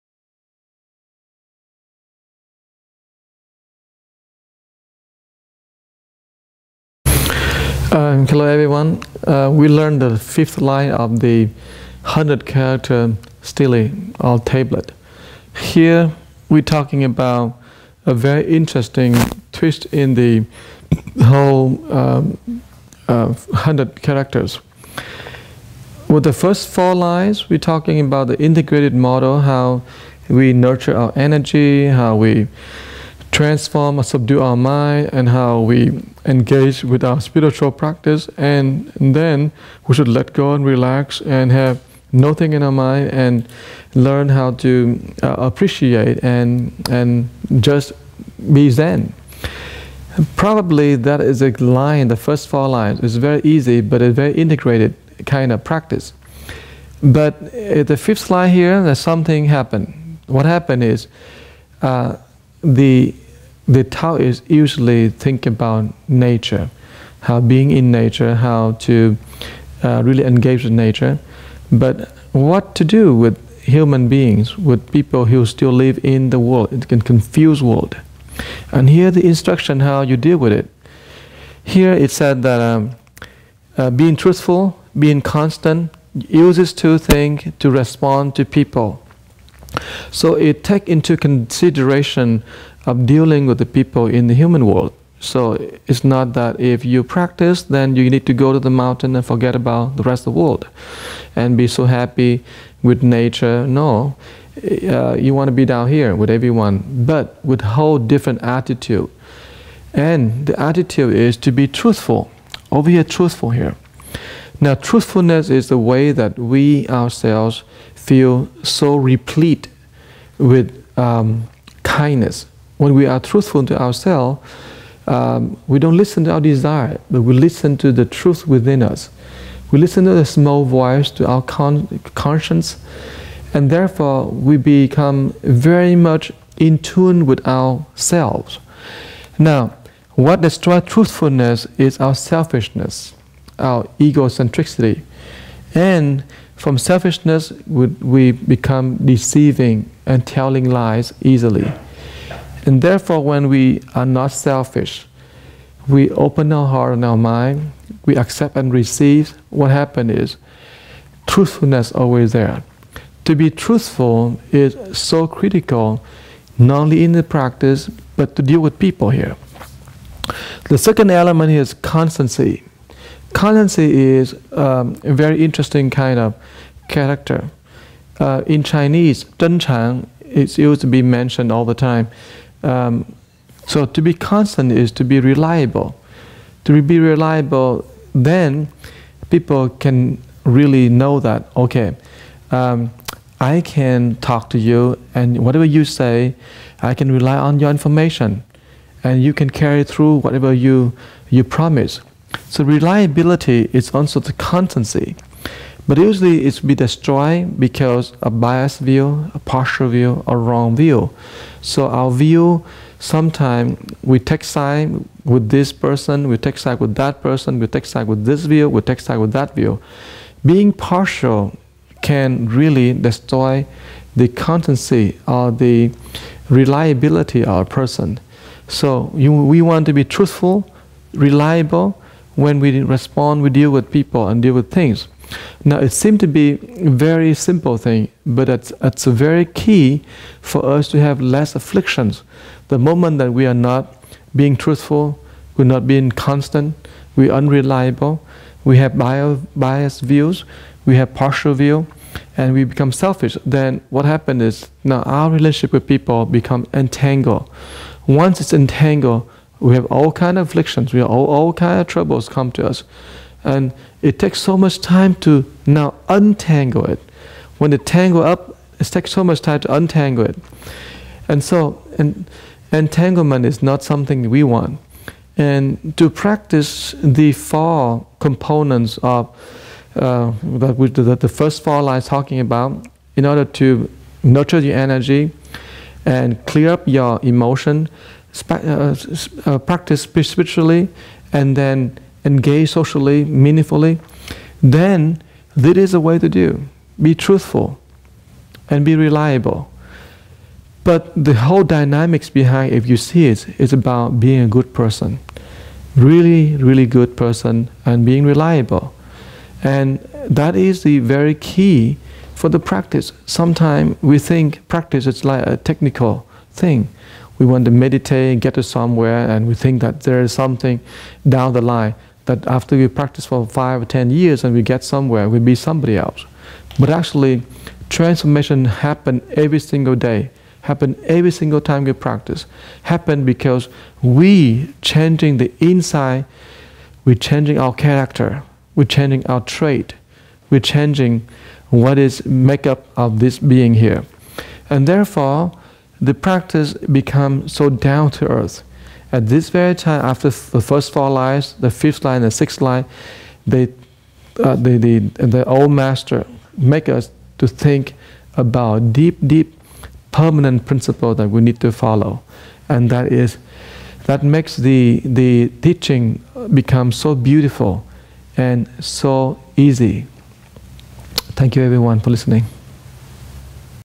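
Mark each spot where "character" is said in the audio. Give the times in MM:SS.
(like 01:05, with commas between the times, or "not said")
00:12, 00:24, 02:56, 05:37.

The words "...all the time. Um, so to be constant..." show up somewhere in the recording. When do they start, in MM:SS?
03:01.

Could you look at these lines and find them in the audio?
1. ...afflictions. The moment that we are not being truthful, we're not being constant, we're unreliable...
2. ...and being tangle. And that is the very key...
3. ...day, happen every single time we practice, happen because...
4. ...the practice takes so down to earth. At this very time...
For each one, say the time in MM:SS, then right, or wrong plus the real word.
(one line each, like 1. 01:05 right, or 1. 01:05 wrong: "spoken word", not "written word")
1. 04:01 right
2. 05:07 wrong: "reliable", not "tangle"
3. 05:29 right
4. 05:46 wrong: "becomes", not "takes".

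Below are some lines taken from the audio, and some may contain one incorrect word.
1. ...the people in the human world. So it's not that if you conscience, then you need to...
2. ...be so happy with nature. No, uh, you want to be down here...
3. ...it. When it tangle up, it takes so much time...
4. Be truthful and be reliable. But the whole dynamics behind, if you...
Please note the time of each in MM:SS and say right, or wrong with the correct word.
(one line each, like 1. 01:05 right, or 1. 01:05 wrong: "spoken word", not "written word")
1. 01:33 wrong: "practice", not "conscience"
2. 01:41 right
3. 04:26 right
4. 04:57 right.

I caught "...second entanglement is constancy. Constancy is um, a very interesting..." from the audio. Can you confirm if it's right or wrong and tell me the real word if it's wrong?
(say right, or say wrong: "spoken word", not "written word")
wrong: "element", not "entanglement".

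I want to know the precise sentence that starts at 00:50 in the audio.
Probably that is a line, the first four lines.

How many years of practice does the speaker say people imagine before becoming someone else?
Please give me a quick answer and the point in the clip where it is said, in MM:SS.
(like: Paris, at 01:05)
five or ten years, at 05:23.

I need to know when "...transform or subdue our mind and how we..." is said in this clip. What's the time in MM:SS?
00:33.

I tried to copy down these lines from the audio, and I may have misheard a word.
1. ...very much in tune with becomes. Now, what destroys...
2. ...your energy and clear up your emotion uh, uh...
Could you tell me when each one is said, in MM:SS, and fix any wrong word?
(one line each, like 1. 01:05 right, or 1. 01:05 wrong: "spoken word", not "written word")
1. 02:15 wrong: "ourselves", not "becomes"
2. 04:44 right.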